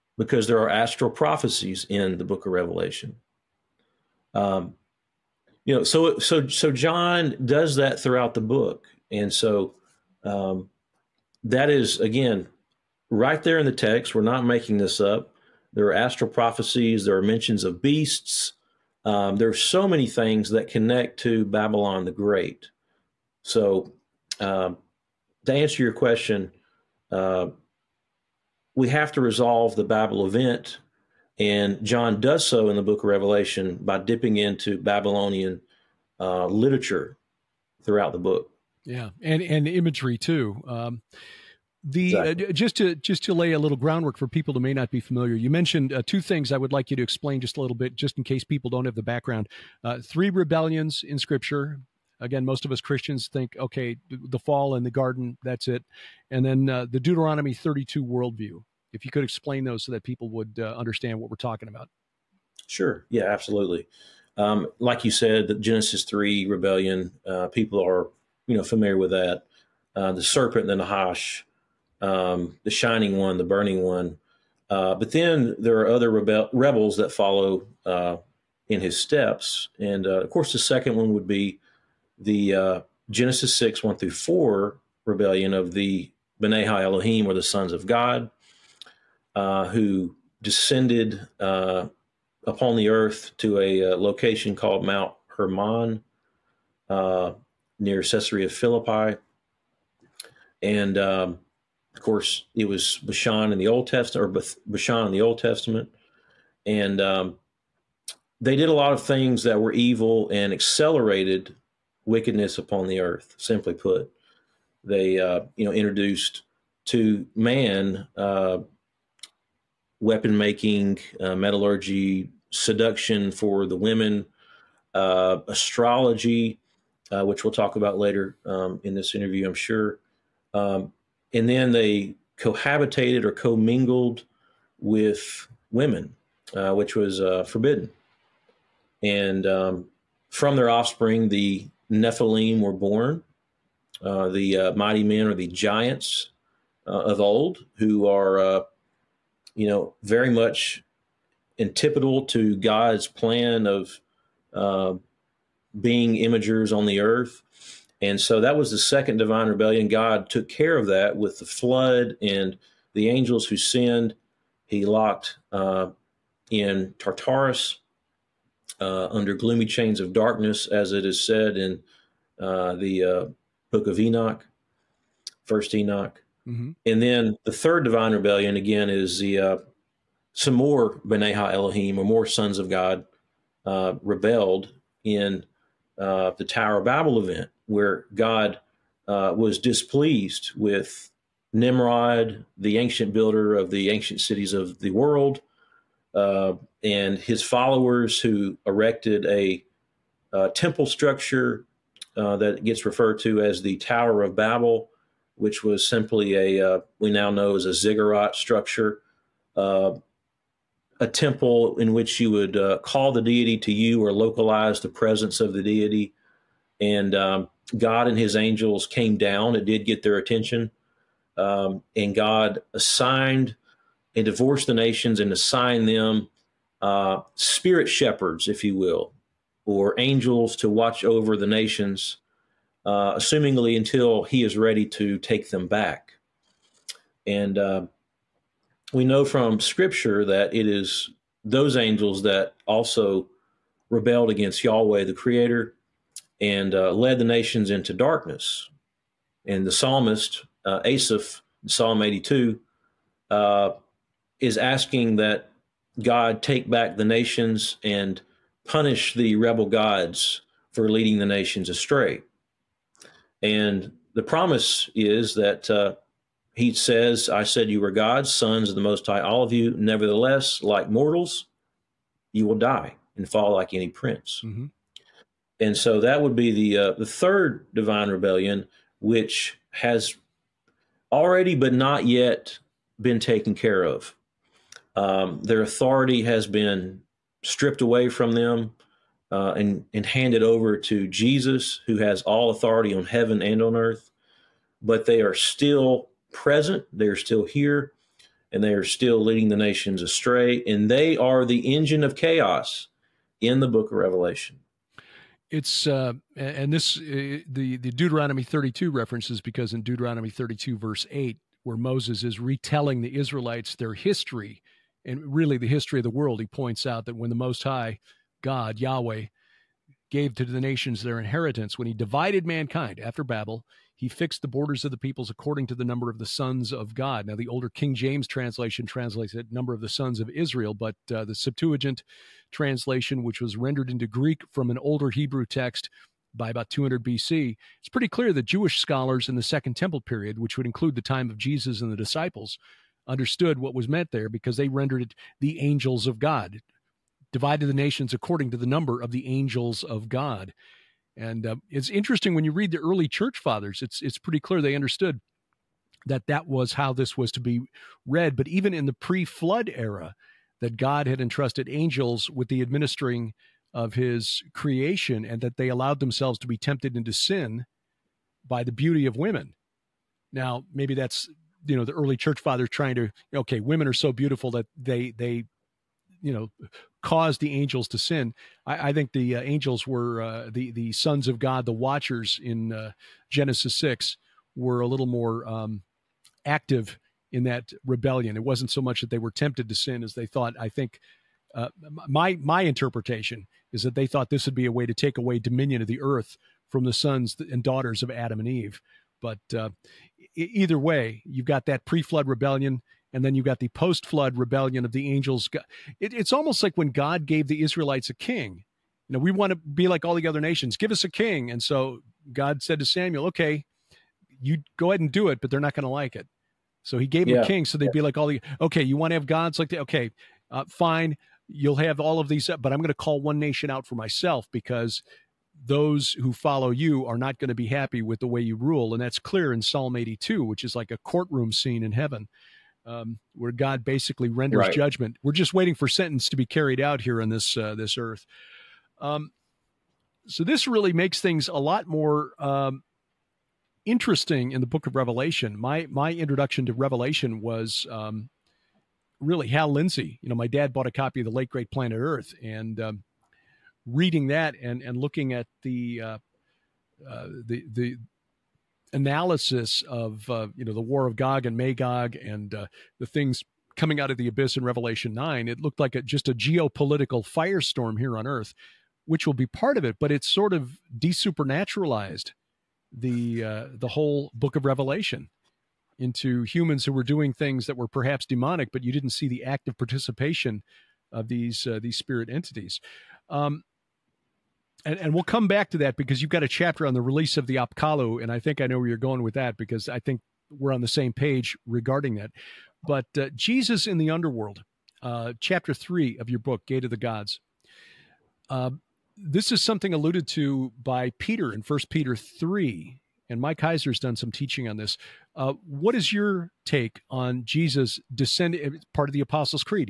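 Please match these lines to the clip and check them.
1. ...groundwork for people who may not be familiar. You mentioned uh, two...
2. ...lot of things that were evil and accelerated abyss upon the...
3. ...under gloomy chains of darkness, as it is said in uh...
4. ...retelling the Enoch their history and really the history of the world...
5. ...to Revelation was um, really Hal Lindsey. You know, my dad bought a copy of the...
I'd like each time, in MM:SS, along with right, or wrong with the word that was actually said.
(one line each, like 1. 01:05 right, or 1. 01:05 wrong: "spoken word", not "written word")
1. 00:43 right
2. 01:48 wrong: "wickedness", not "abyss"
3. 02:49 right
4. 05:12 wrong: "Israelites", not "Enoch"
5. 07:26 right.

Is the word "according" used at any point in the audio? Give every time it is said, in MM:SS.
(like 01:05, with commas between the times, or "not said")
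05:25, 05:48.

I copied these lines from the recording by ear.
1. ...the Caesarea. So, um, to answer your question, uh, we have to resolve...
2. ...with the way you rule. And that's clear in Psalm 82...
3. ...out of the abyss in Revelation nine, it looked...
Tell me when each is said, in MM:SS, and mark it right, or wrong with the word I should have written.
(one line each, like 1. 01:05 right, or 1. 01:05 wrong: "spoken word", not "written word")
1. 00:22 wrong: "Great", not "Caesarea"
2. 07:08 right
3. 07:44 right.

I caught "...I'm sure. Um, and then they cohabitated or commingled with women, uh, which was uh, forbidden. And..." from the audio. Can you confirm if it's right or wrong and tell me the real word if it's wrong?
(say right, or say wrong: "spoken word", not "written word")
right.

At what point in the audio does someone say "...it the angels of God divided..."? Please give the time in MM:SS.
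05:45.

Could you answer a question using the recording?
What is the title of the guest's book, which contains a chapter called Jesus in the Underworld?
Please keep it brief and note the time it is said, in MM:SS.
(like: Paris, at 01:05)
Gate of the Gods, at 08:16.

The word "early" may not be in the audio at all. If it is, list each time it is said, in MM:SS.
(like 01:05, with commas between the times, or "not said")
05:52, 06:11.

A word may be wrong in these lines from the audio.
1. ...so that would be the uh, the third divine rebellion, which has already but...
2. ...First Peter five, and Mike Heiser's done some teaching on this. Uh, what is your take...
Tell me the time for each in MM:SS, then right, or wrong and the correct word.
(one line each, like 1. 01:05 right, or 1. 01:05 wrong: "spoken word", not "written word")
1. 04:35 right
2. 08:21 wrong: "three", not "five".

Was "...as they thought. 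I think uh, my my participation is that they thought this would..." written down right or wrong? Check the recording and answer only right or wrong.
wrong.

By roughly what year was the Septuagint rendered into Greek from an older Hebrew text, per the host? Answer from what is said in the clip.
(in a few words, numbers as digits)
200 BC.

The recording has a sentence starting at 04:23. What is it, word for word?
And the promise is that uh, he says, I said you were God's sons of the Most High, all of you.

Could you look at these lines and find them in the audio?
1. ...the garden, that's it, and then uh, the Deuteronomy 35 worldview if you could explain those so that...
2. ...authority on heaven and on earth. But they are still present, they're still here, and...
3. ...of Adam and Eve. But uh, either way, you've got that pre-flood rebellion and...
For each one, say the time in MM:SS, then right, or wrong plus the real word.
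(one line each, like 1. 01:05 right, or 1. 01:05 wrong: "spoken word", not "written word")
1. 00:54 wrong: "32", not "35"
2. 04:52 right
3. 06:38 right.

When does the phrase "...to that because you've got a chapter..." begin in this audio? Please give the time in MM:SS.
08:05.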